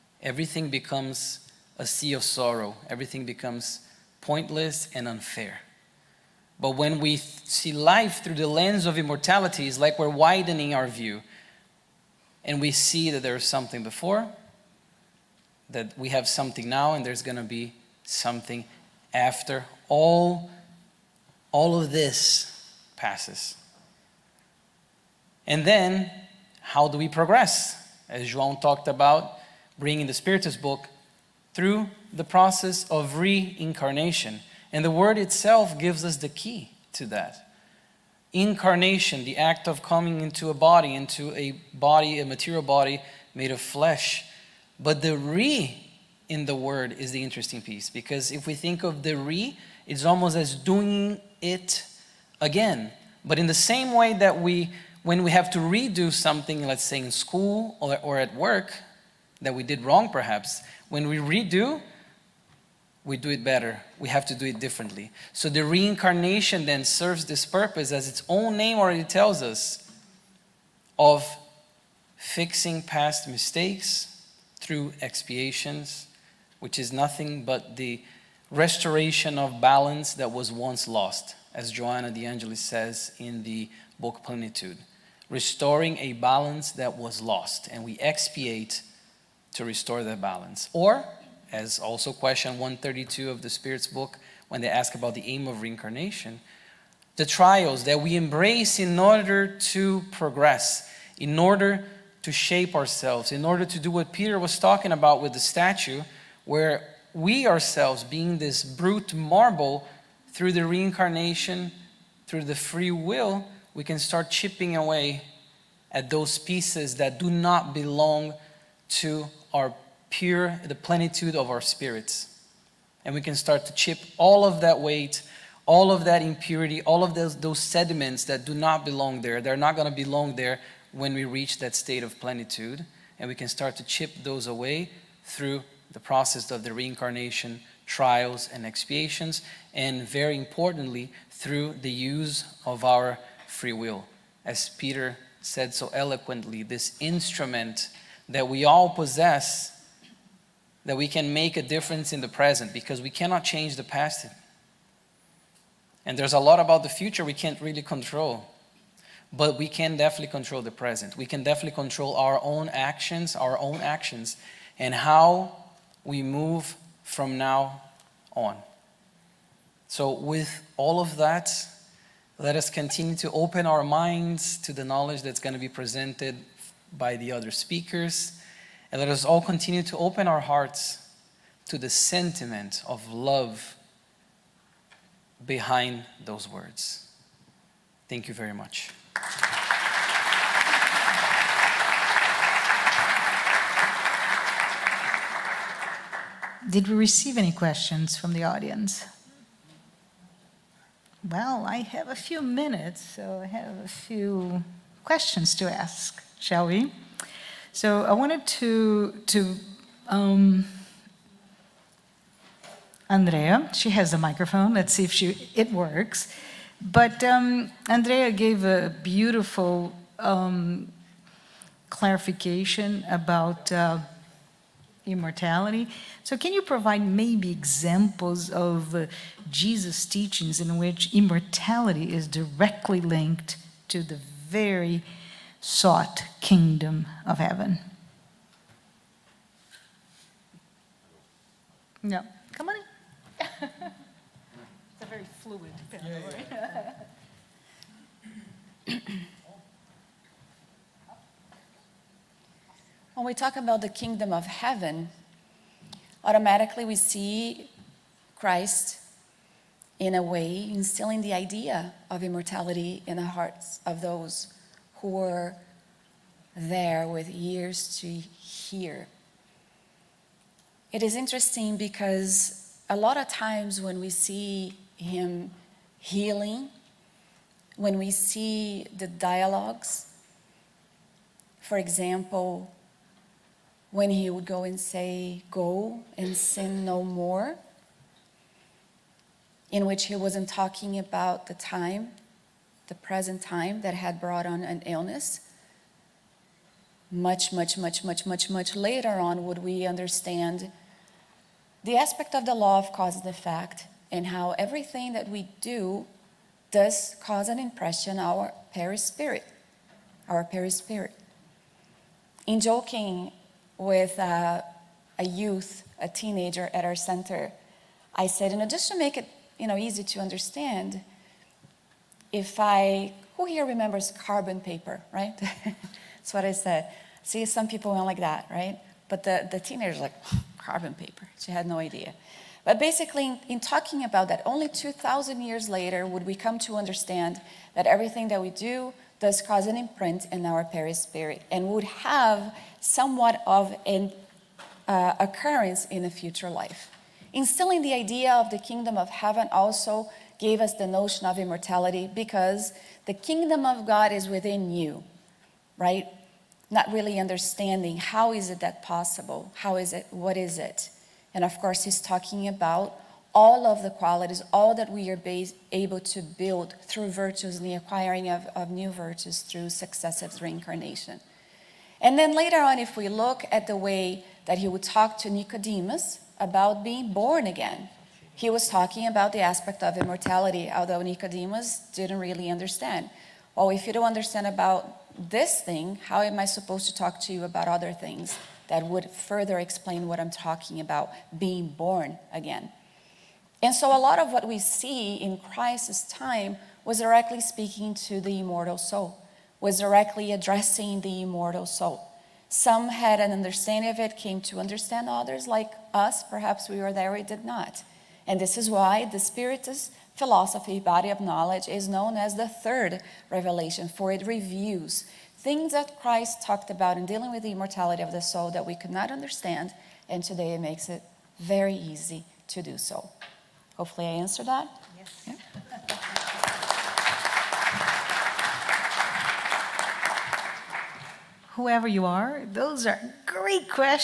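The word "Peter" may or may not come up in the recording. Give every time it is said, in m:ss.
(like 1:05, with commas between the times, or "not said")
1:44, 2:24.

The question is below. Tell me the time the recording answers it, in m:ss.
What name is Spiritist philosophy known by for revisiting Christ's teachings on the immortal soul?
6:52.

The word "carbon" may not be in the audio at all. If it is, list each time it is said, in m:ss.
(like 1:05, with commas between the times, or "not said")
5:24, 5:30.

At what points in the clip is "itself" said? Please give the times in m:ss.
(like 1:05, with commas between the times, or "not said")
0:35.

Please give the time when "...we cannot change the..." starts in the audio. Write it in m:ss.
2:33.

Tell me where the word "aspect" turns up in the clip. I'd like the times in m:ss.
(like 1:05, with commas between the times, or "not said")
5:01, 6:19.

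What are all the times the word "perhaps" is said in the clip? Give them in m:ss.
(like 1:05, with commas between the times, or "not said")
1:00, 6:46.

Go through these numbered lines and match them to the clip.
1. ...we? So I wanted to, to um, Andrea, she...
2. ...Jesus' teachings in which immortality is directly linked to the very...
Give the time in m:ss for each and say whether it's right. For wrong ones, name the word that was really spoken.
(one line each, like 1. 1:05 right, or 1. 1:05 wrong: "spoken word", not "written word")
1. 3:26 right
2. 3:49 right.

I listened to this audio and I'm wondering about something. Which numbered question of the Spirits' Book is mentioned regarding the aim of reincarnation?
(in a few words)
132.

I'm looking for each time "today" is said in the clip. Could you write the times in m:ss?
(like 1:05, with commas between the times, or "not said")
7:00.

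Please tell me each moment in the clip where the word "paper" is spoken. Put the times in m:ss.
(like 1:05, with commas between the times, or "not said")
5:24, 5:30.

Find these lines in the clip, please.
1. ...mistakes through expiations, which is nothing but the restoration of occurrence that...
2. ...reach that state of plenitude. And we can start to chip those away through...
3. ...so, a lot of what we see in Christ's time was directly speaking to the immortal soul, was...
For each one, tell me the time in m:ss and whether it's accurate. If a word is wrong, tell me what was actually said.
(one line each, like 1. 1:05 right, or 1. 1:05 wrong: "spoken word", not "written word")
1. 1:13 wrong: "balance", not "occurrence"
2. 2:11 right
3. 6:33 right.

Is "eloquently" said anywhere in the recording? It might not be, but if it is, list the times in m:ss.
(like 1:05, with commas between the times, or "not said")
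2:25.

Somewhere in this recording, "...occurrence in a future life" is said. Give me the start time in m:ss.
5:45.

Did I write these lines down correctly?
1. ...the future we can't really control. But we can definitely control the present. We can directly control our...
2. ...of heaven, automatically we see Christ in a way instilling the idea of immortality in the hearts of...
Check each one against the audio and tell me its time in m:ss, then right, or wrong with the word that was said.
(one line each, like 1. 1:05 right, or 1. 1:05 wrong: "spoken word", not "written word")
1. 2:36 wrong: "definitely", not "directly"
2. 4:14 right.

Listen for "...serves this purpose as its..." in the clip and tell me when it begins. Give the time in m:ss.
1:06.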